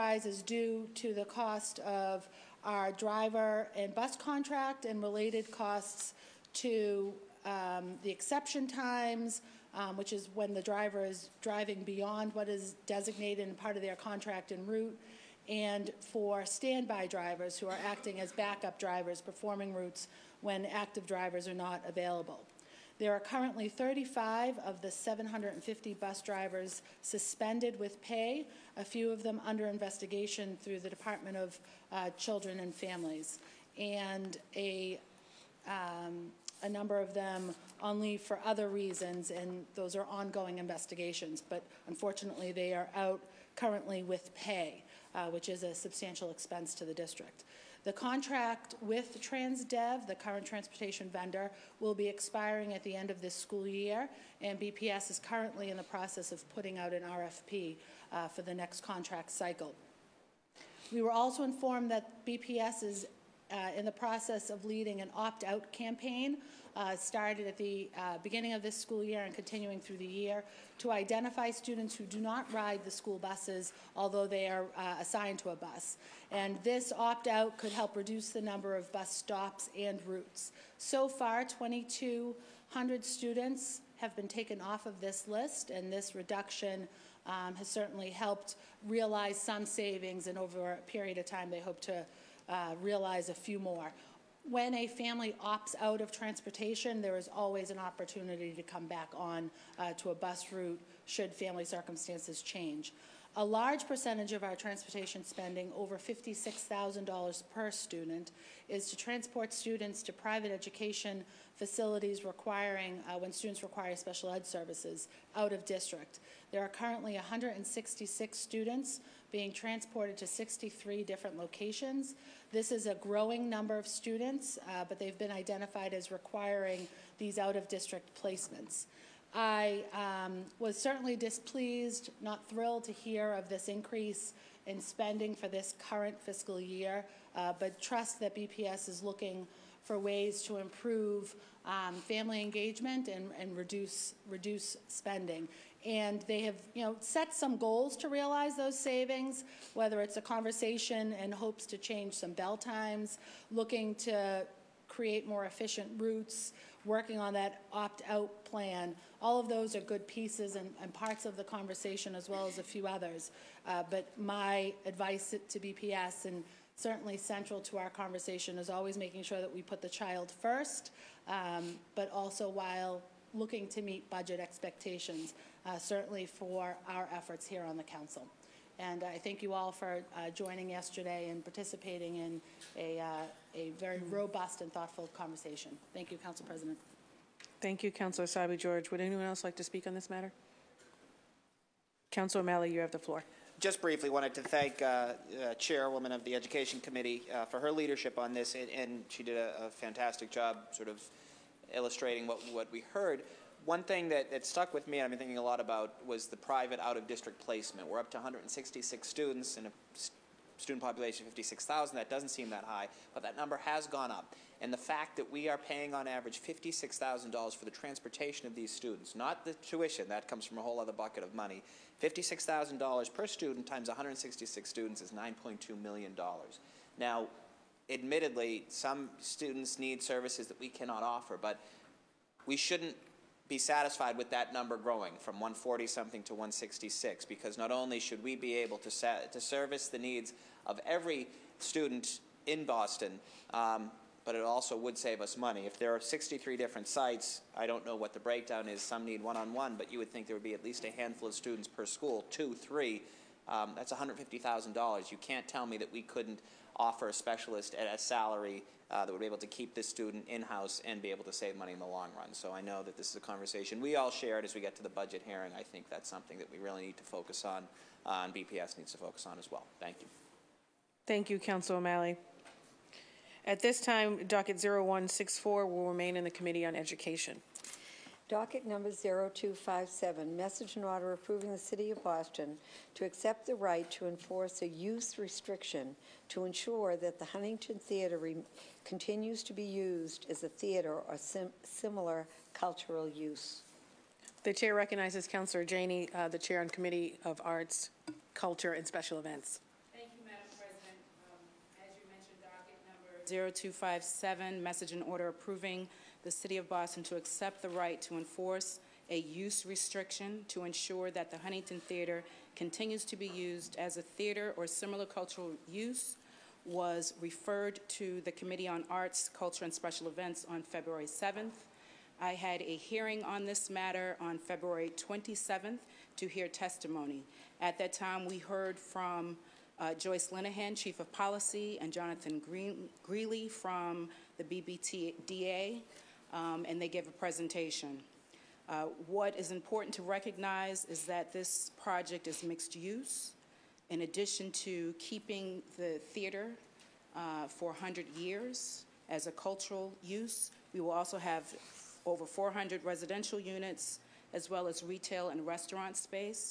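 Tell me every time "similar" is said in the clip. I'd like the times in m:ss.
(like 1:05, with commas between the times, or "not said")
4:51, 5:14.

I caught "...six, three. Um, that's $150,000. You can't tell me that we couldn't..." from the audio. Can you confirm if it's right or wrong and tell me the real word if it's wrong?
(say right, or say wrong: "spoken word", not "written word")
wrong: "two", not "six".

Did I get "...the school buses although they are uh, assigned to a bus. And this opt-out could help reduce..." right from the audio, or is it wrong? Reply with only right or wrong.
right.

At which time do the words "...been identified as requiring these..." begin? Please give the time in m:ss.
2:05.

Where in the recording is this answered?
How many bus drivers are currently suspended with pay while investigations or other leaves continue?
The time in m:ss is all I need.
0:23.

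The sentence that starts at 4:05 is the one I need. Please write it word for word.
If there are 63 different sites, I don't know what the breakdown is.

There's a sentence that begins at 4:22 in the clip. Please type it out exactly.
So I know that this is a conversation we all shared as we get to the budget hearing.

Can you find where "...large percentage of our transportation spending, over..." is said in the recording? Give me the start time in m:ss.
1:43.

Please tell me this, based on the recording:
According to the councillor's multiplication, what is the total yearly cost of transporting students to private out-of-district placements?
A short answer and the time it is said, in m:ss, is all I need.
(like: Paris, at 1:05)
$9.2 million, at 3:45.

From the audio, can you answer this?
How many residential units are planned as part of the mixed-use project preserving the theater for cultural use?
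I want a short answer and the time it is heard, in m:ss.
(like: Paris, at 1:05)
over 400, at 5:52.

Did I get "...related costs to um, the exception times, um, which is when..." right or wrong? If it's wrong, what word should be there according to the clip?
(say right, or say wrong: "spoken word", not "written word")
right.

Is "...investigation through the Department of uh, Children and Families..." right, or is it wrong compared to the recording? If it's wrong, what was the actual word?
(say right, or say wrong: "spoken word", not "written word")
right.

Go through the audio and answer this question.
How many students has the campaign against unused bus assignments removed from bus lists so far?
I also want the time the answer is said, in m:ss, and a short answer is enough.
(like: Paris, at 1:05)
2,200, at 1:21.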